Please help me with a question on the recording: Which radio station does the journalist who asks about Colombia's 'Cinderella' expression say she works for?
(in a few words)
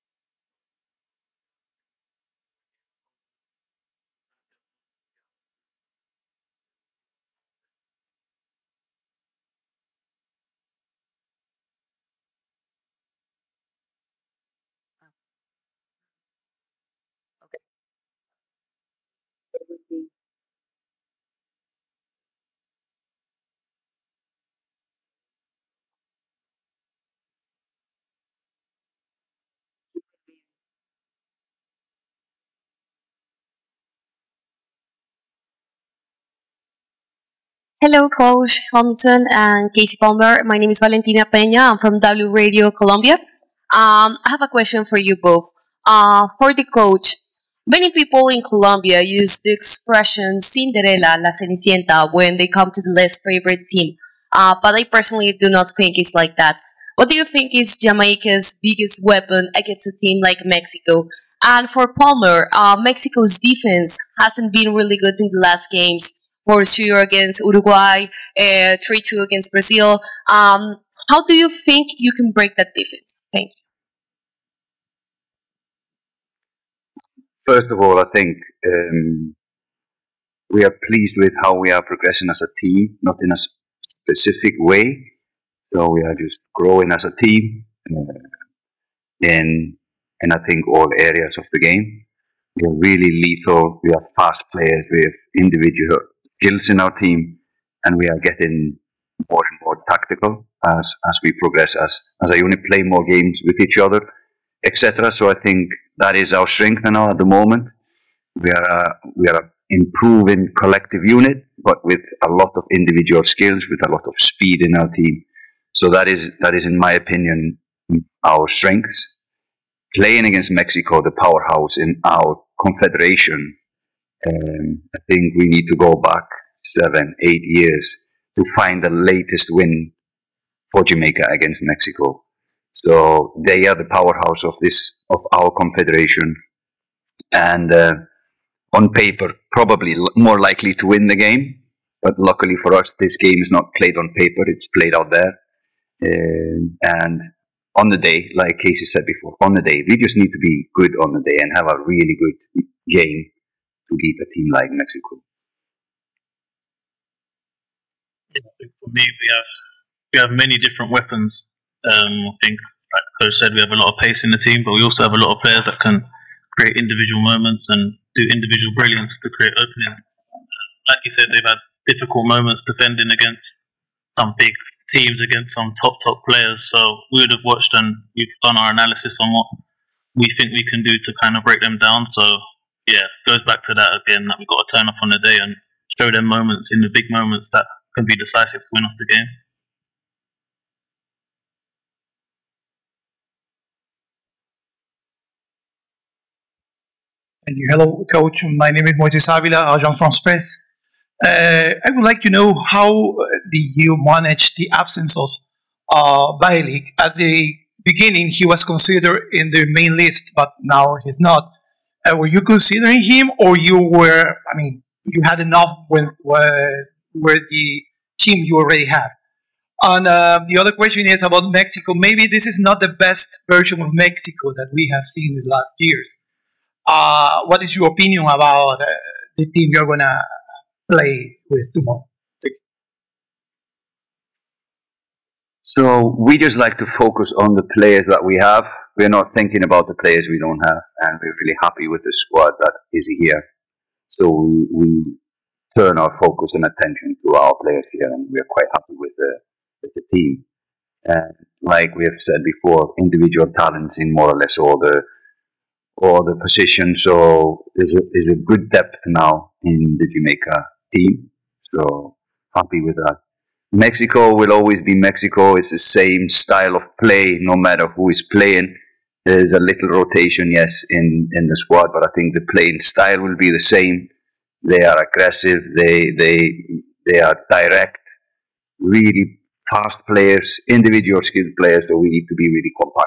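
W Radio Colombia.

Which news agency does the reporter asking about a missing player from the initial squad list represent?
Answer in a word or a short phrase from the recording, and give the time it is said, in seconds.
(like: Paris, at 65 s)
Agence France-Presse, at 199 s.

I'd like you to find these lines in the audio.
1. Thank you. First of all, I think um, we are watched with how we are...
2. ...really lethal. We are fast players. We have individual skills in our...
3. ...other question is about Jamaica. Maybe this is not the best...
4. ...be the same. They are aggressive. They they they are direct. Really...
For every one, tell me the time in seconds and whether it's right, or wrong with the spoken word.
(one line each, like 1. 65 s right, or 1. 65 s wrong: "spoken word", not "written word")
1. 73 s wrong: "pleased", not "watched"
2. 92 s right
3. 220 s wrong: "Mexico", not "Jamaica"
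4. 273 s right.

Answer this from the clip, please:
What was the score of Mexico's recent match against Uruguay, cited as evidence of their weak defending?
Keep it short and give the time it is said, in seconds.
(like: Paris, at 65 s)
4-2, at 66 s.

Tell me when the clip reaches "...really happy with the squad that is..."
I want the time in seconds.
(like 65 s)
241 s.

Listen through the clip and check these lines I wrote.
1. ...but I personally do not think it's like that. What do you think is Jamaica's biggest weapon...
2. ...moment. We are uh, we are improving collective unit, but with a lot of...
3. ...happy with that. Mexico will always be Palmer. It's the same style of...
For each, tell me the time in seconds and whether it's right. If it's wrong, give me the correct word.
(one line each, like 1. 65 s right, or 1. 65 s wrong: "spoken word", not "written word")
1. 54 s right
2. 107 s right
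3. 262 s wrong: "Mexico", not "Palmer".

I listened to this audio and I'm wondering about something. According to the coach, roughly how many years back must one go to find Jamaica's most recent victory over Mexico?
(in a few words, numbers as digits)
7 or 8 years.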